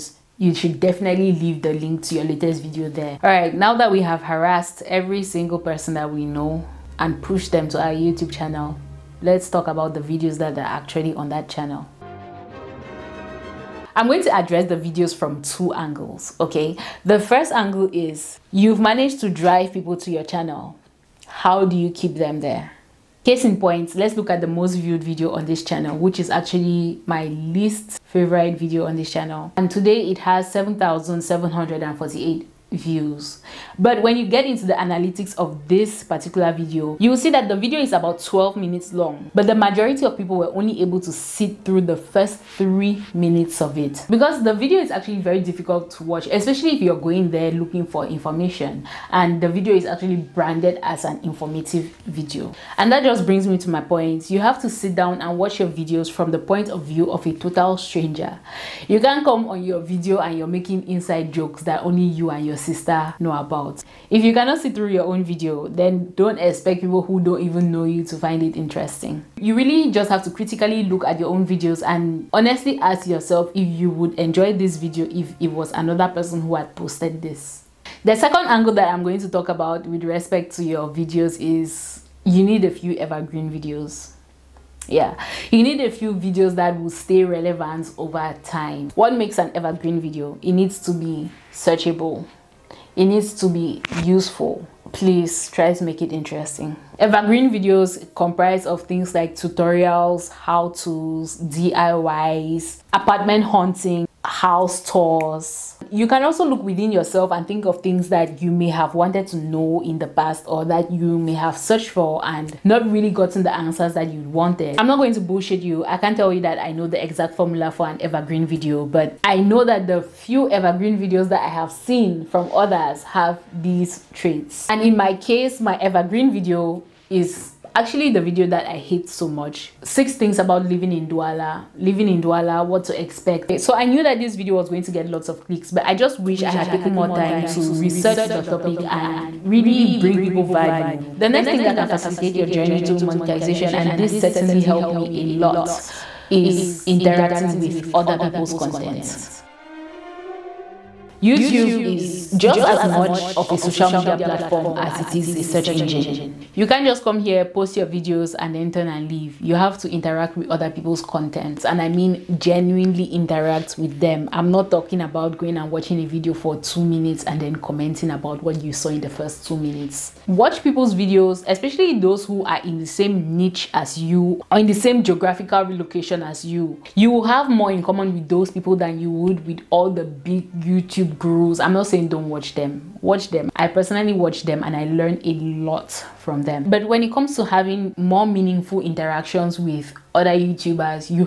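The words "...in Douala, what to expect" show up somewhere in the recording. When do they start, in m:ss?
2:12.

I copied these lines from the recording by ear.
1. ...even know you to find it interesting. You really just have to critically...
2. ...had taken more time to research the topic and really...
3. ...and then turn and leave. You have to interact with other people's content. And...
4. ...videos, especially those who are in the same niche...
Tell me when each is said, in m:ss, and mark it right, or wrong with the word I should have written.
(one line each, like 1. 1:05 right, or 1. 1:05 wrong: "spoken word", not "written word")
1. 1:07 right
2. 2:16 right
3. 2:38 right
4. 2:50 right.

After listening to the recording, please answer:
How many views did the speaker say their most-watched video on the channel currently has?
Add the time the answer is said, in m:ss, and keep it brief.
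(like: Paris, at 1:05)
7,748, at 0:30.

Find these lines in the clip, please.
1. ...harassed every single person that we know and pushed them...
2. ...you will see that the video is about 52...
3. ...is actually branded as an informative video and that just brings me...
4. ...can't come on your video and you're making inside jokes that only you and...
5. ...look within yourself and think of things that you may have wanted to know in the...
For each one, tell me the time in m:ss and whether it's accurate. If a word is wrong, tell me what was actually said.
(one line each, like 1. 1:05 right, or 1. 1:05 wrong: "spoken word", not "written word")
1. 0:04 right
2. 0:36 wrong: "12", not "52"
3. 0:49 right
4. 0:58 right
5. 1:46 right.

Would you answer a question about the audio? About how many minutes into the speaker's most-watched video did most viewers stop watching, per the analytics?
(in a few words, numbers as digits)
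3 minutes.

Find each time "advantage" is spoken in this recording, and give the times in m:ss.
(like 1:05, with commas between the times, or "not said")
not said.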